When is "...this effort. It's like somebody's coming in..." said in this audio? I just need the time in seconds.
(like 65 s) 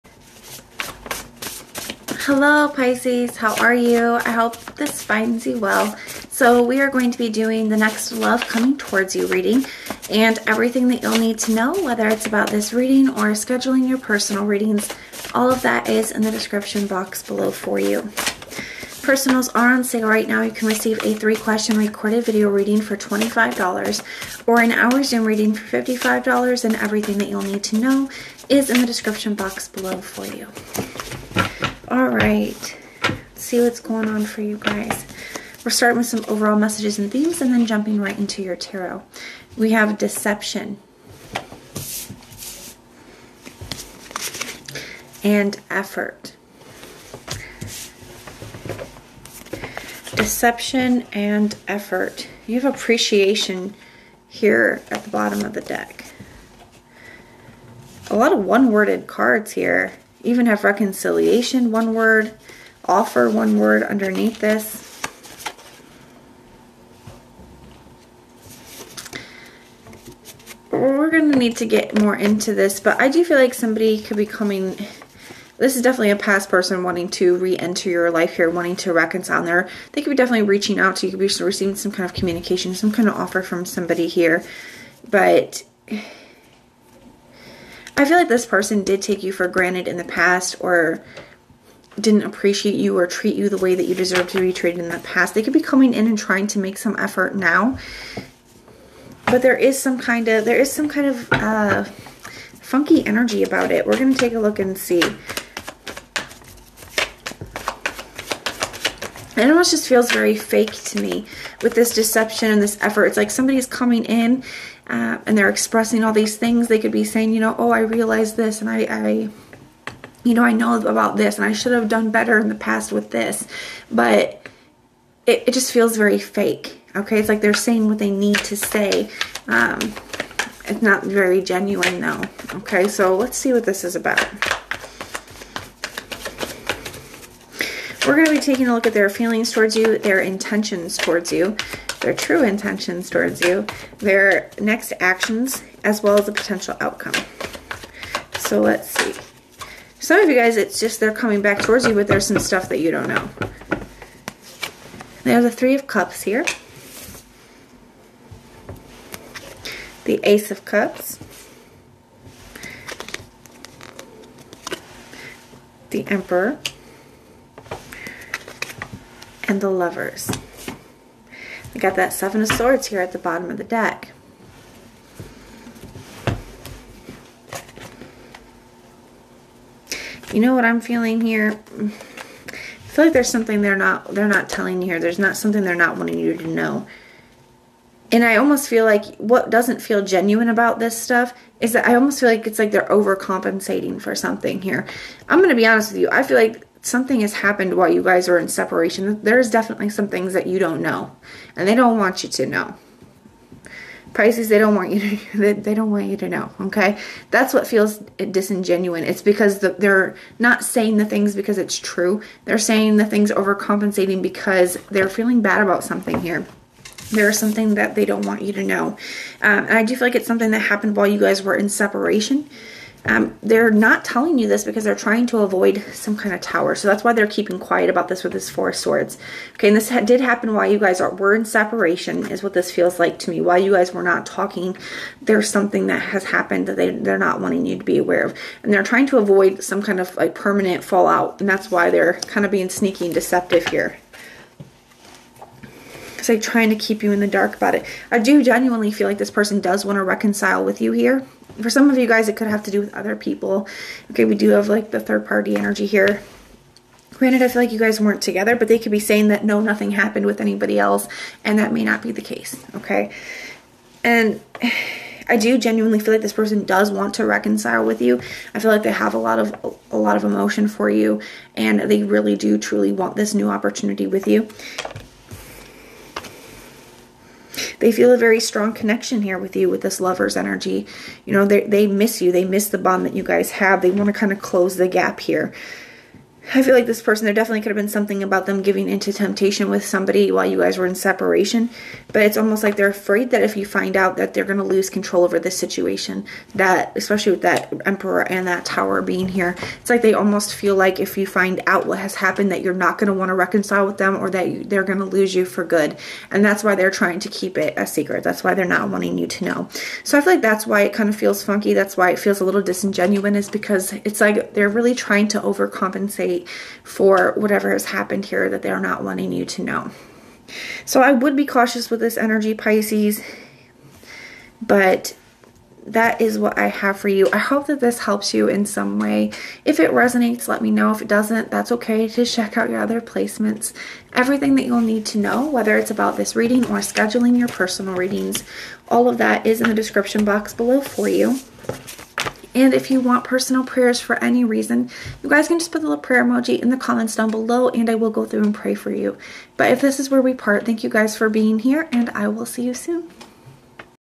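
112 s.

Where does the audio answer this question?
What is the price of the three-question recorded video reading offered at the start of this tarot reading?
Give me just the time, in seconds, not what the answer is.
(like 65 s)
22 s.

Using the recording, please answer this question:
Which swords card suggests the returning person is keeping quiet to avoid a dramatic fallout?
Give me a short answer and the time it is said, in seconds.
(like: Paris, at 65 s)
Four of Swords, at 228 s.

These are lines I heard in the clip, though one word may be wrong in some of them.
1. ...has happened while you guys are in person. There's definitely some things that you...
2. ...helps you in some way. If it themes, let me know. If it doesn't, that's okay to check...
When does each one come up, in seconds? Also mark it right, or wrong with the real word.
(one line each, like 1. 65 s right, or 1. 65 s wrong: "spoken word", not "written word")
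1. 197 s wrong: "separation", not "person"
2. 327 s wrong: "resonates", not "themes".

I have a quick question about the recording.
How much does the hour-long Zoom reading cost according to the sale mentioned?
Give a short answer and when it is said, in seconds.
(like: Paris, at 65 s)
$55, at 25 s.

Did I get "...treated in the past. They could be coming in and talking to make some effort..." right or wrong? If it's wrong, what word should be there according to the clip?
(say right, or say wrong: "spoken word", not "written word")
wrong: "trying", not "talking".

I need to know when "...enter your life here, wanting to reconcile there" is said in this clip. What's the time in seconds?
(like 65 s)
77 s.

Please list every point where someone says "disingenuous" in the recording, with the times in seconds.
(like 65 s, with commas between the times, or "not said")
208 s, 312 s.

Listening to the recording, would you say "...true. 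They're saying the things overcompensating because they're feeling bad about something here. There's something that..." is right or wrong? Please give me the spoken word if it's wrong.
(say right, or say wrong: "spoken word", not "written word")
right.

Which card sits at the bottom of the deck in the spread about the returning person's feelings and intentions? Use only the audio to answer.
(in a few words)
Seven of Swords.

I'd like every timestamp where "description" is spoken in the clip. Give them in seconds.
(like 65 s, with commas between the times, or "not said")
16 s, 28 s, 339 s.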